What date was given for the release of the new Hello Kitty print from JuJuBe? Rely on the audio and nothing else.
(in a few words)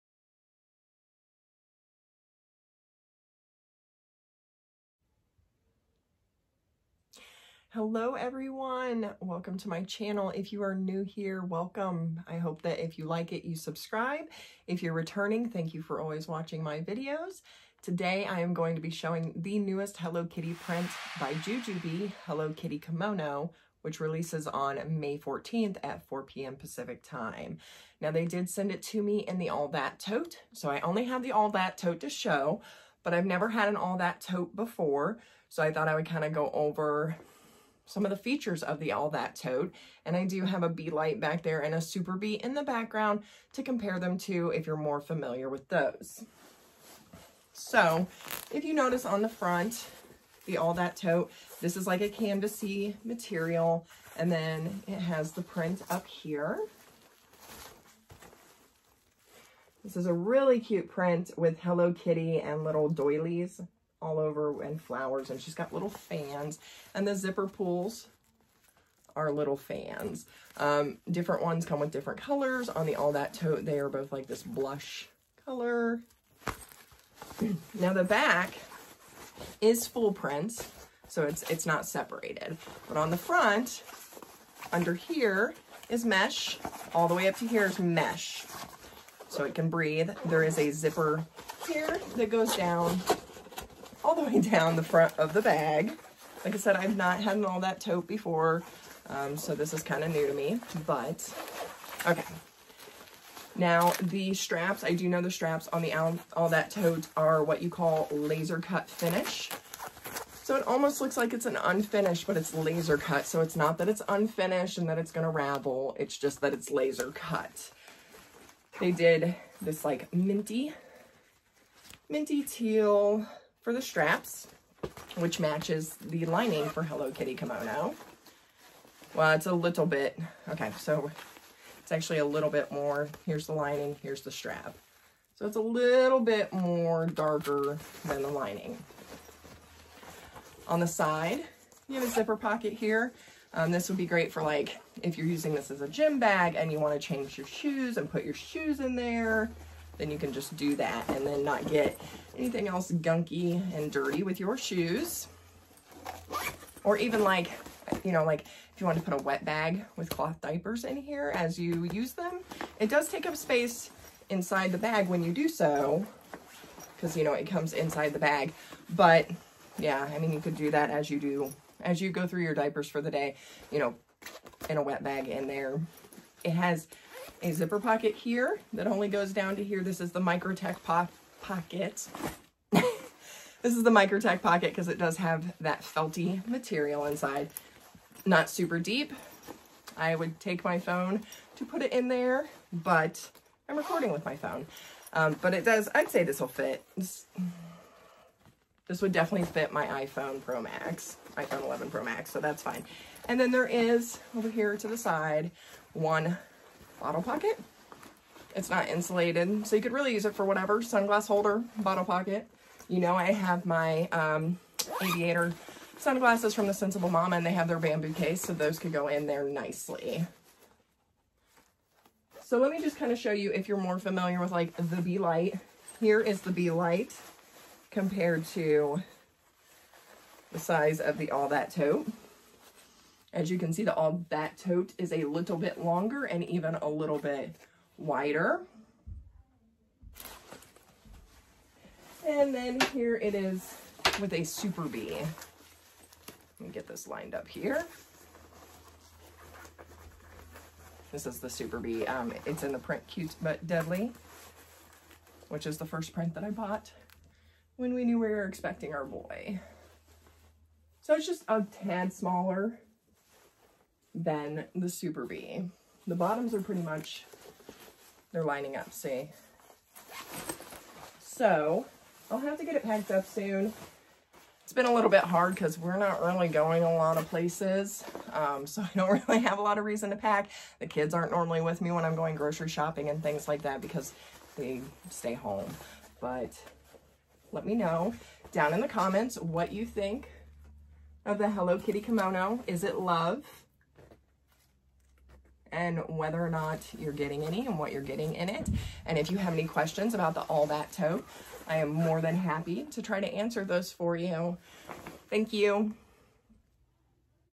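May 14th.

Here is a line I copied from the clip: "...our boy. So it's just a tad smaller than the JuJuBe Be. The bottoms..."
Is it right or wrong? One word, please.
wrong.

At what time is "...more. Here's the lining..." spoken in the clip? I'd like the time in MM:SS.
02:12.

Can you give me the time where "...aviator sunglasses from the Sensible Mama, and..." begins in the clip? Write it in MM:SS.
03:35.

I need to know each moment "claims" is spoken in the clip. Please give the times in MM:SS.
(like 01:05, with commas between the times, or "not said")
not said.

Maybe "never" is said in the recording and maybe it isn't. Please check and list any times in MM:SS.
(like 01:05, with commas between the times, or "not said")
00:33.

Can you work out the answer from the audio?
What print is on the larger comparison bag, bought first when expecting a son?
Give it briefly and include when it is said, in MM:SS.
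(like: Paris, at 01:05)
Cute But Deadly, at 04:13.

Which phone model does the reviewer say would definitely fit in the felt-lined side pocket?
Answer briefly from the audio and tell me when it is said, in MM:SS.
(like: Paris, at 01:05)
iPhone 11 Pro Max, at 03:21.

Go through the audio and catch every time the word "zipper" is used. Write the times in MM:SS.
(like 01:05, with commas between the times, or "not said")
01:07, 01:30, 02:22, 02:57.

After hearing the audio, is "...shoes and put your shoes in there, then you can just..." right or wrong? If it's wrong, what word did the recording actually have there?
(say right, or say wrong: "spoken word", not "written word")
right.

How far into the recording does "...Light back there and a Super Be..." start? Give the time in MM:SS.
00:40.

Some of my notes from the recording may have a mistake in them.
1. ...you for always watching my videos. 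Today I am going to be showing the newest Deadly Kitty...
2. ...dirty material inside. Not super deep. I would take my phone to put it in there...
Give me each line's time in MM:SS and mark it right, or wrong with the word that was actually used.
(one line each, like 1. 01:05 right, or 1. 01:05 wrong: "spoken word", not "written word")
1. 00:15 wrong: "Hello", not "Deadly"
2. 03:05 wrong: "felty", not "dirty".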